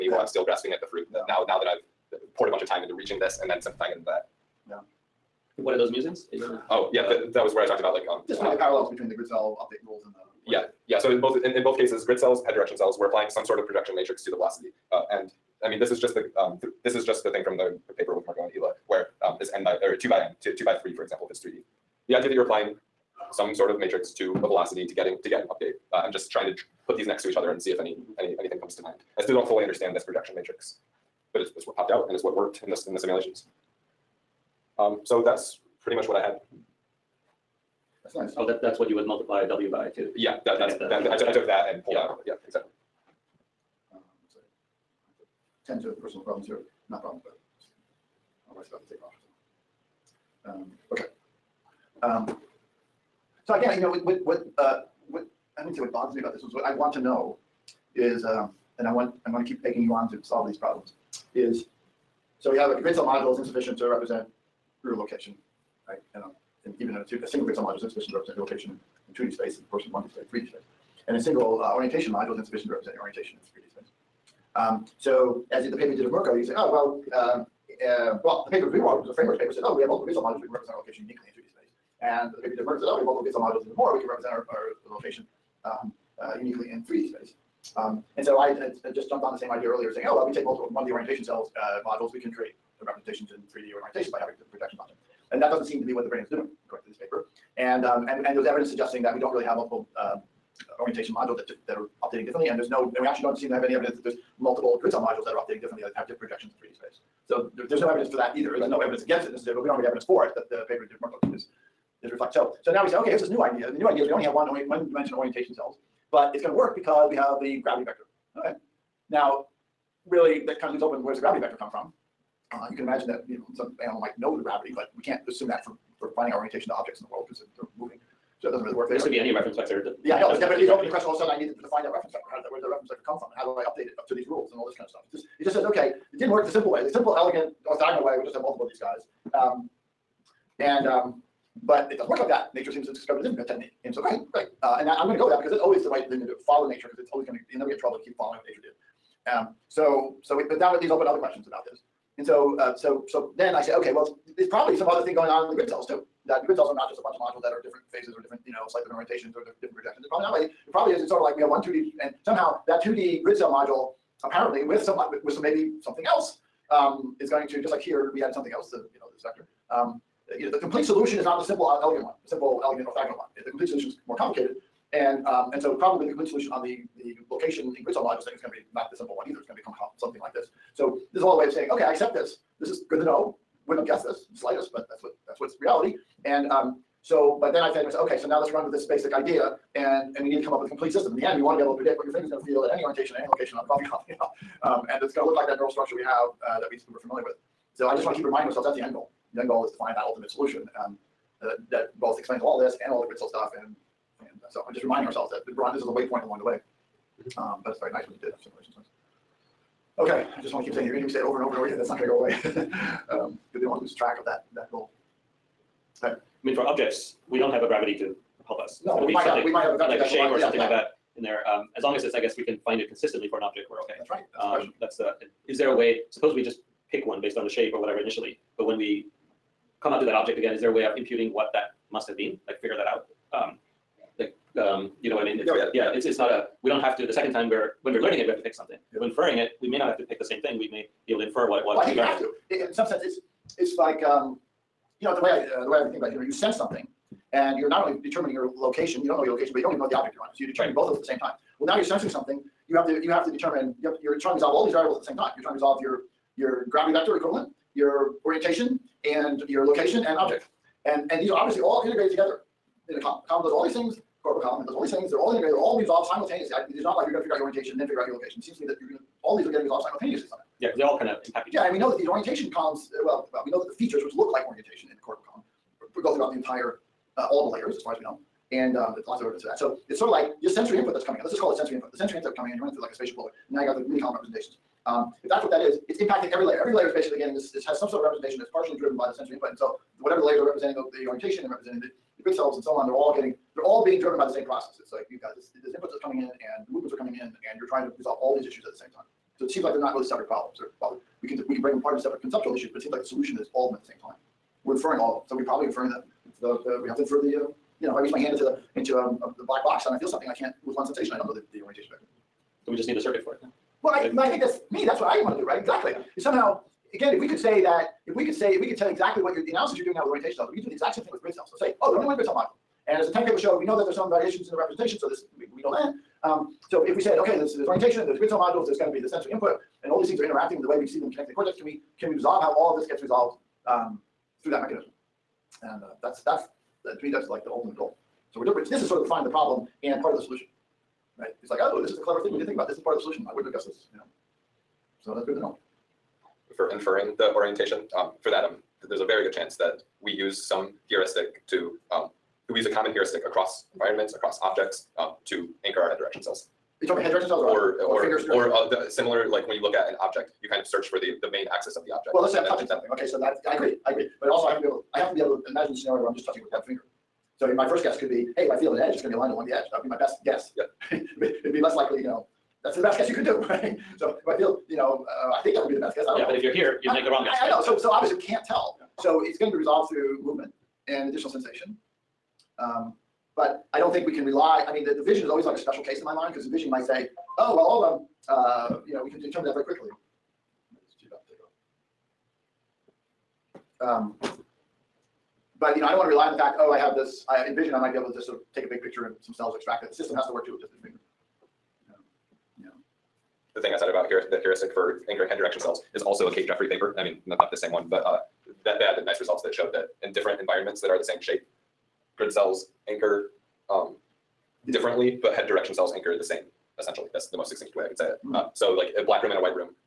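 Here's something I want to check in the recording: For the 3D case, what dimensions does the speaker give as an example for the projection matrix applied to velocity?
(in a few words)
2 by 3.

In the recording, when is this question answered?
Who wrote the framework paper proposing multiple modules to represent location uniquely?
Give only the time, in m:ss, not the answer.
1:18.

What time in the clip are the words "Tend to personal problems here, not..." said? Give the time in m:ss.
0:45.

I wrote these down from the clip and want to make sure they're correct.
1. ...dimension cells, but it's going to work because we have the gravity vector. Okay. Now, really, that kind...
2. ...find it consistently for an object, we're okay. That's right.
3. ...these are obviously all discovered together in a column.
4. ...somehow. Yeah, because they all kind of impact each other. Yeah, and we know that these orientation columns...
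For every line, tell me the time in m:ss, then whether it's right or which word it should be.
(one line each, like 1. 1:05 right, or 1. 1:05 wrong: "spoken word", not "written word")
1. 1:55 wrong: "orientation", not "dimension"
2. 3:42 right
3. 4:21 wrong: "integrated", not "discovered"
4. 4:30 right.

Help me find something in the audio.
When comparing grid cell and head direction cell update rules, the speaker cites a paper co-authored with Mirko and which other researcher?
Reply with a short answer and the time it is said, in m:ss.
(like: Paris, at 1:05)
Ila, at 0:18.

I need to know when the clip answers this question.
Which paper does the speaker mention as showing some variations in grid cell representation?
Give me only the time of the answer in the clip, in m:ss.
5:23.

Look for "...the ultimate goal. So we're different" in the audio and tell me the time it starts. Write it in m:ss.
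5:37.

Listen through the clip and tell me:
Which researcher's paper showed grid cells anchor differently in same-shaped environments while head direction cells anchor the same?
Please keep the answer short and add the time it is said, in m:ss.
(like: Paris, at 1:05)
Kate Jeffery, at 6:46.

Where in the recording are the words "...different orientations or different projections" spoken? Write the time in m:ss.
2:38.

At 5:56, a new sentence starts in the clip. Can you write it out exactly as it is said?
You talking about head direction cells or, or, or, or fingers?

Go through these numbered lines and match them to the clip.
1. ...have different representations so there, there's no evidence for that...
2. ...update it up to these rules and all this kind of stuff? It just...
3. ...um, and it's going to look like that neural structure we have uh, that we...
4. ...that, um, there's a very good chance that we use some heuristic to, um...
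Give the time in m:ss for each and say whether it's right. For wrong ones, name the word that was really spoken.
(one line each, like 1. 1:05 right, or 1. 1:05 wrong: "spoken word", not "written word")
1. 1:45 wrong: "projections", not "representations"
2. 2:13 right
3. 3:14 right
4. 5:48 right.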